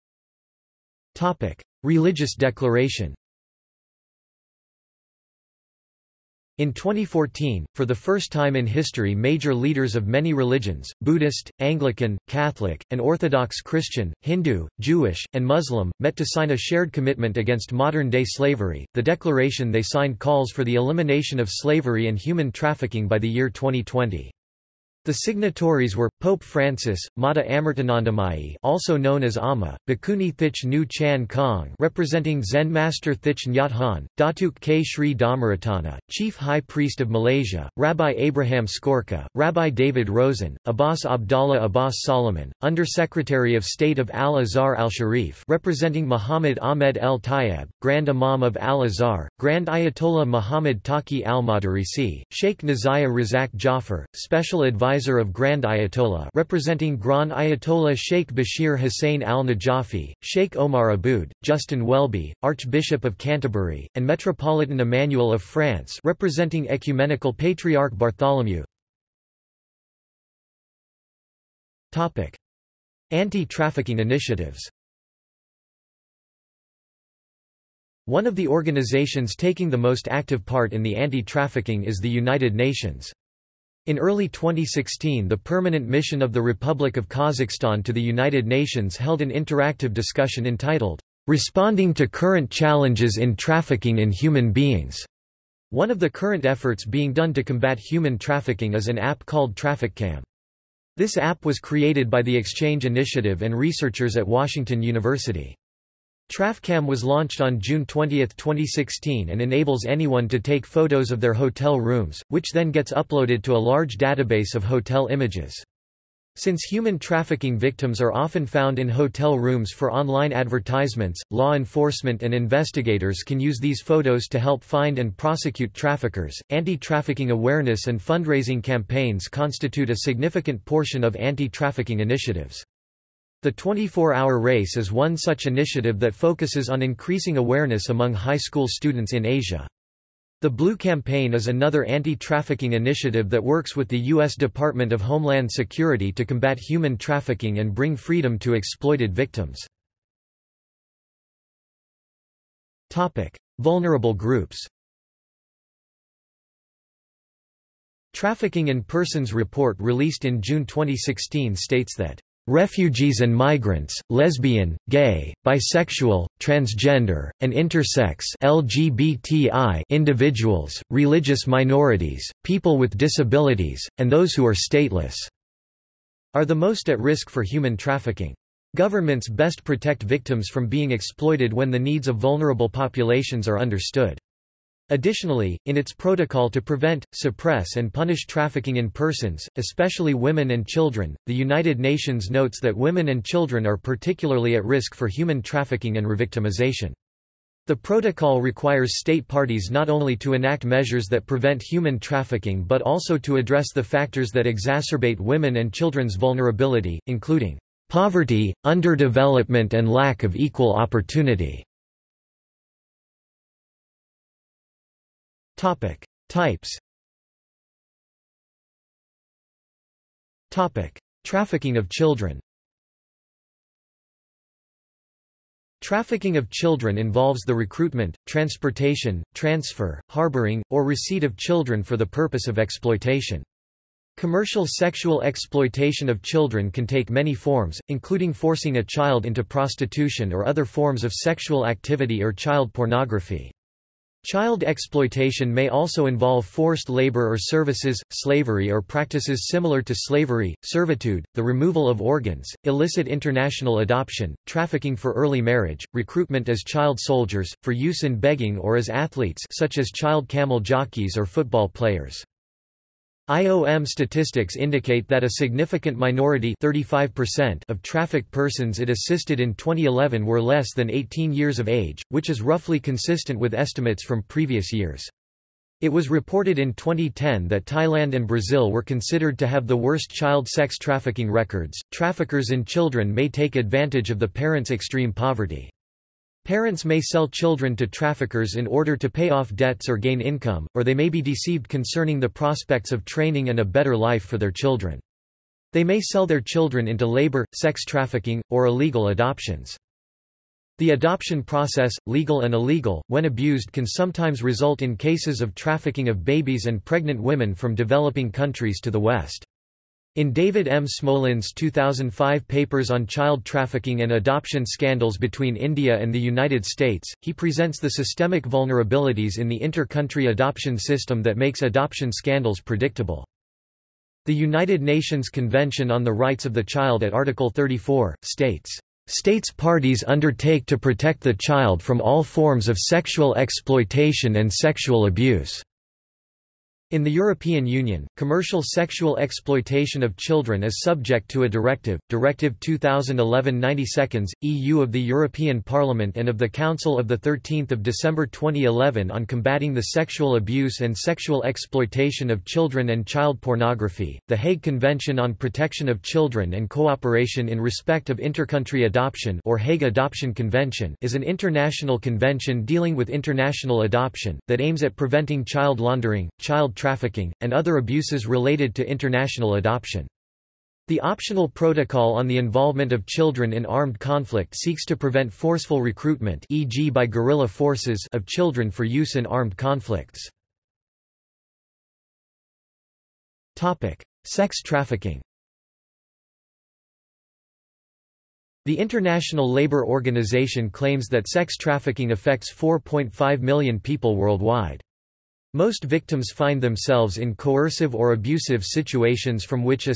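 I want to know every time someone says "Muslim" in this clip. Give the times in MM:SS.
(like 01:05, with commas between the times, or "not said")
00:15.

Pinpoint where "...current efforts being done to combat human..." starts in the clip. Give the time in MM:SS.
01:36.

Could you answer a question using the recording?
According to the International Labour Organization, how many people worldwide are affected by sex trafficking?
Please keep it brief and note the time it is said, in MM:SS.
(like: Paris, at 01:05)
4.5 million, at 06:32.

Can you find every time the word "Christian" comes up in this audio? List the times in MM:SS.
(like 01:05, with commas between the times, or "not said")
00:13.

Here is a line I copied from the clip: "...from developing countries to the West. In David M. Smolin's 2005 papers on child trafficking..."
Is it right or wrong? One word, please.
right.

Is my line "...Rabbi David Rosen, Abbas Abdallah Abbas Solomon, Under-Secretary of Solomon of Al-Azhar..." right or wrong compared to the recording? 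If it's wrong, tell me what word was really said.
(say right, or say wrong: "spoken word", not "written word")
wrong: "State", not "Solomon".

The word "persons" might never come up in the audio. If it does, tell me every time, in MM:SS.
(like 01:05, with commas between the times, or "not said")
02:38, 03:08, 04:28.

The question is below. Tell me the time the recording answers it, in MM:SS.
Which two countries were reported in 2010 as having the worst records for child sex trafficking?
04:37.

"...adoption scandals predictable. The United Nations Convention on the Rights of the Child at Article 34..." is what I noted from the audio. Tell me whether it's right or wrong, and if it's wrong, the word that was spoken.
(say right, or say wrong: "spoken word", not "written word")
right.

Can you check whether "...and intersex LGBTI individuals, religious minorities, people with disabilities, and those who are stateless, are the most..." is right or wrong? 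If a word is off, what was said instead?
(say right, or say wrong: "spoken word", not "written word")
right.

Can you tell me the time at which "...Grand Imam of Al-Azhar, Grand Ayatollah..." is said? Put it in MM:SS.
00:47.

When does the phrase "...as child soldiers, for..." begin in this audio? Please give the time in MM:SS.
04:16.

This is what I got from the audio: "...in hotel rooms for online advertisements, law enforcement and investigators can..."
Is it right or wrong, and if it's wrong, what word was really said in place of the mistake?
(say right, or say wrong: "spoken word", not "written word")
right.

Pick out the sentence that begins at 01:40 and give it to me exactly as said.
This app was created by the Exchange Initiative and researchers at Washington University.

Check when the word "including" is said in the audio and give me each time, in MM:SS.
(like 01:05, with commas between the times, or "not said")
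03:27, 03:57.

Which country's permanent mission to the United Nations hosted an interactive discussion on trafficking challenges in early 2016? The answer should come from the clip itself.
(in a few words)
Kazakhstan.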